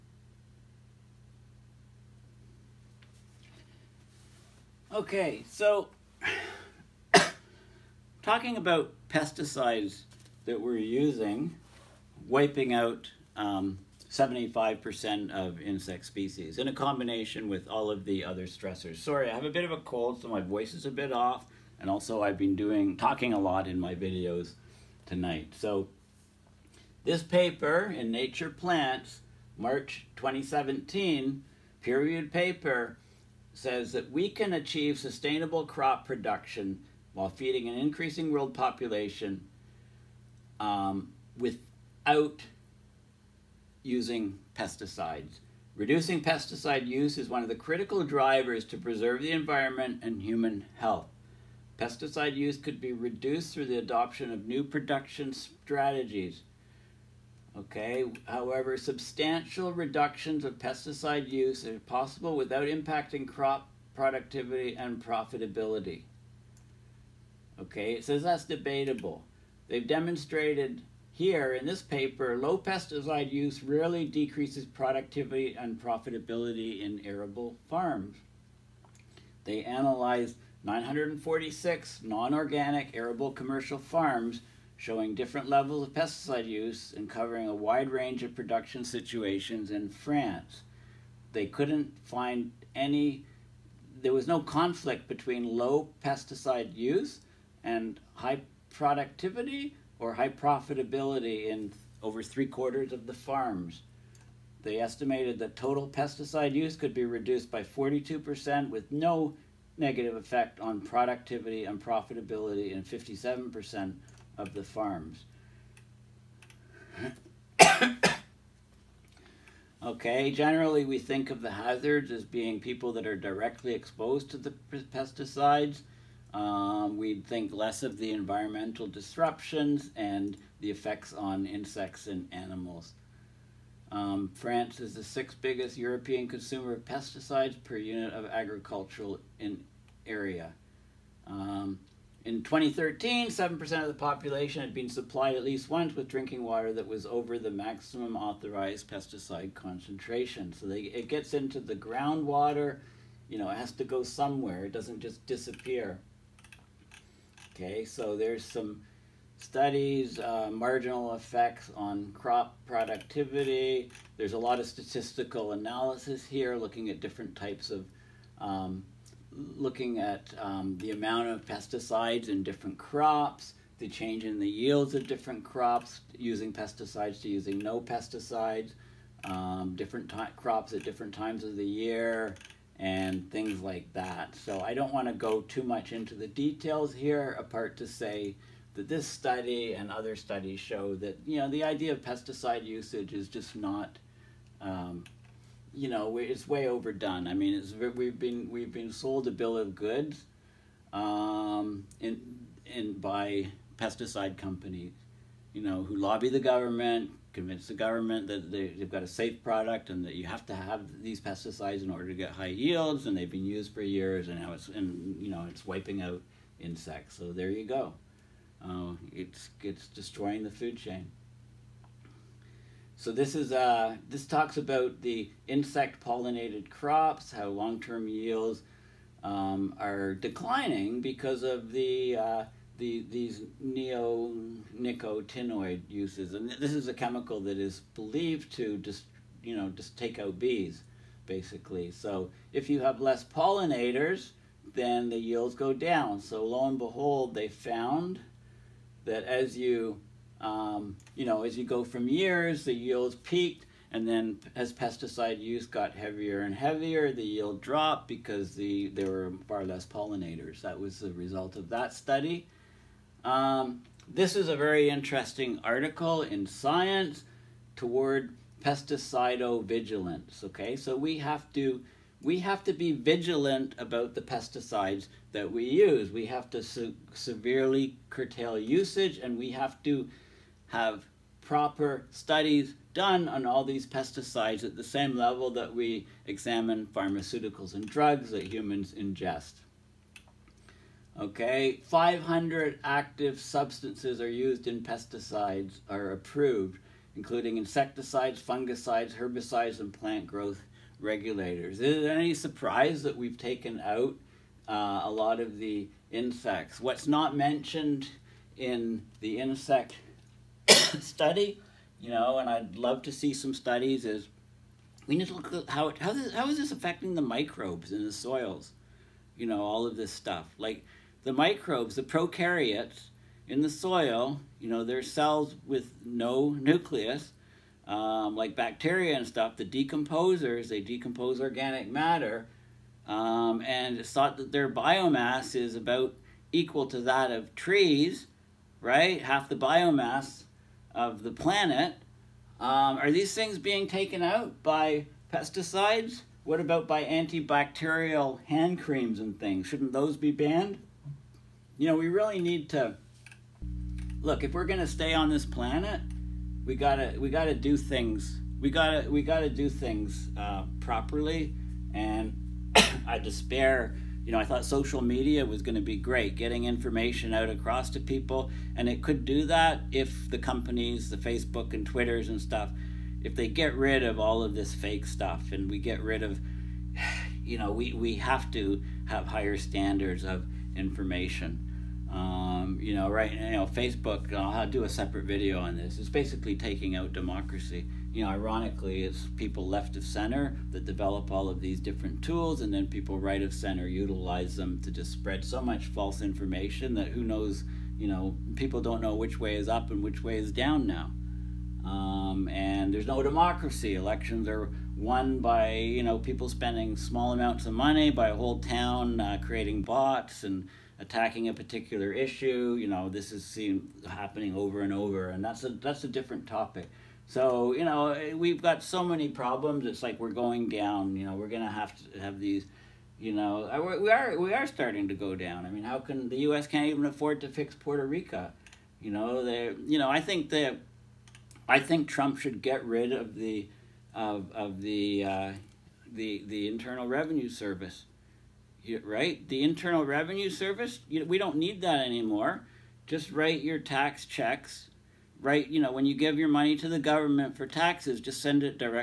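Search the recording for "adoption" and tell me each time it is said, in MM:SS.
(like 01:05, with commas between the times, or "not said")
00:53.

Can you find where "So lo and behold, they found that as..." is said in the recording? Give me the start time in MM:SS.
04:06.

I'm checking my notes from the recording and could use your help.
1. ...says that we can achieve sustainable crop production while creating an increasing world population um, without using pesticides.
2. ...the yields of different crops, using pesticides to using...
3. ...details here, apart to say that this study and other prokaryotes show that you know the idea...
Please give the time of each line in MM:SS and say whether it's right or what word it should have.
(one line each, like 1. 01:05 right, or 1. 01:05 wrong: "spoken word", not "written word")
1. 00:33 wrong: "feeding", not "creating"
2. 02:54 right
3. 03:06 wrong: "studies", not "prokaryotes".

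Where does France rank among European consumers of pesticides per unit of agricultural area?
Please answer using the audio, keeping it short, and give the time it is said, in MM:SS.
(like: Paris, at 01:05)
sixth, at 02:15.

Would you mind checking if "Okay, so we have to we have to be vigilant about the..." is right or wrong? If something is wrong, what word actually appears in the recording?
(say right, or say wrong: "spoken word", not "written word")
right.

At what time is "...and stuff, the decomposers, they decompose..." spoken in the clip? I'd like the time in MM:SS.
05:29.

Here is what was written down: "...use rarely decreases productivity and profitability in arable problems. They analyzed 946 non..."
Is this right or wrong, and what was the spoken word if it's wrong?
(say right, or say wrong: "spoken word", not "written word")
wrong: "farms", not "problems".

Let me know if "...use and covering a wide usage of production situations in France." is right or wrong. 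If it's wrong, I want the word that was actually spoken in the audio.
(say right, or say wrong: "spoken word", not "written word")
wrong: "range", not "usage".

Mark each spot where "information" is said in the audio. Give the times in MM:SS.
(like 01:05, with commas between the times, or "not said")
06:06, 06:20, 06:36.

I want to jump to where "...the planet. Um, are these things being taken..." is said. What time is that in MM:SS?
05:41.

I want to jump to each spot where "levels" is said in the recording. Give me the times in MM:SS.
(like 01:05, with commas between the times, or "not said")
01:25, 04:45.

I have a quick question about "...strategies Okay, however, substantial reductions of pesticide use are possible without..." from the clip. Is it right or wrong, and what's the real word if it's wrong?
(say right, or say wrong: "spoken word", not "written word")
right.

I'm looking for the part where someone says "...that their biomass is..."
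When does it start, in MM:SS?
05:34.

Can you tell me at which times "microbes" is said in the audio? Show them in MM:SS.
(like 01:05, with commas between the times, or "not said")
05:17, 05:21.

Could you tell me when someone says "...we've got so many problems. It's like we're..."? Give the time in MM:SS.
06:58.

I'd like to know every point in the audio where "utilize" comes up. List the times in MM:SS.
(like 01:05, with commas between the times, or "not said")
06:33.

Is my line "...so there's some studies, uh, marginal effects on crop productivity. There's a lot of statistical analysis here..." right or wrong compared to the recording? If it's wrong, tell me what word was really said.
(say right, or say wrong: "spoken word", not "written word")
right.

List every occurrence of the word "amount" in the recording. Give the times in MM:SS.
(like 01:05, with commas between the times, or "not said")
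02:50, 06:47.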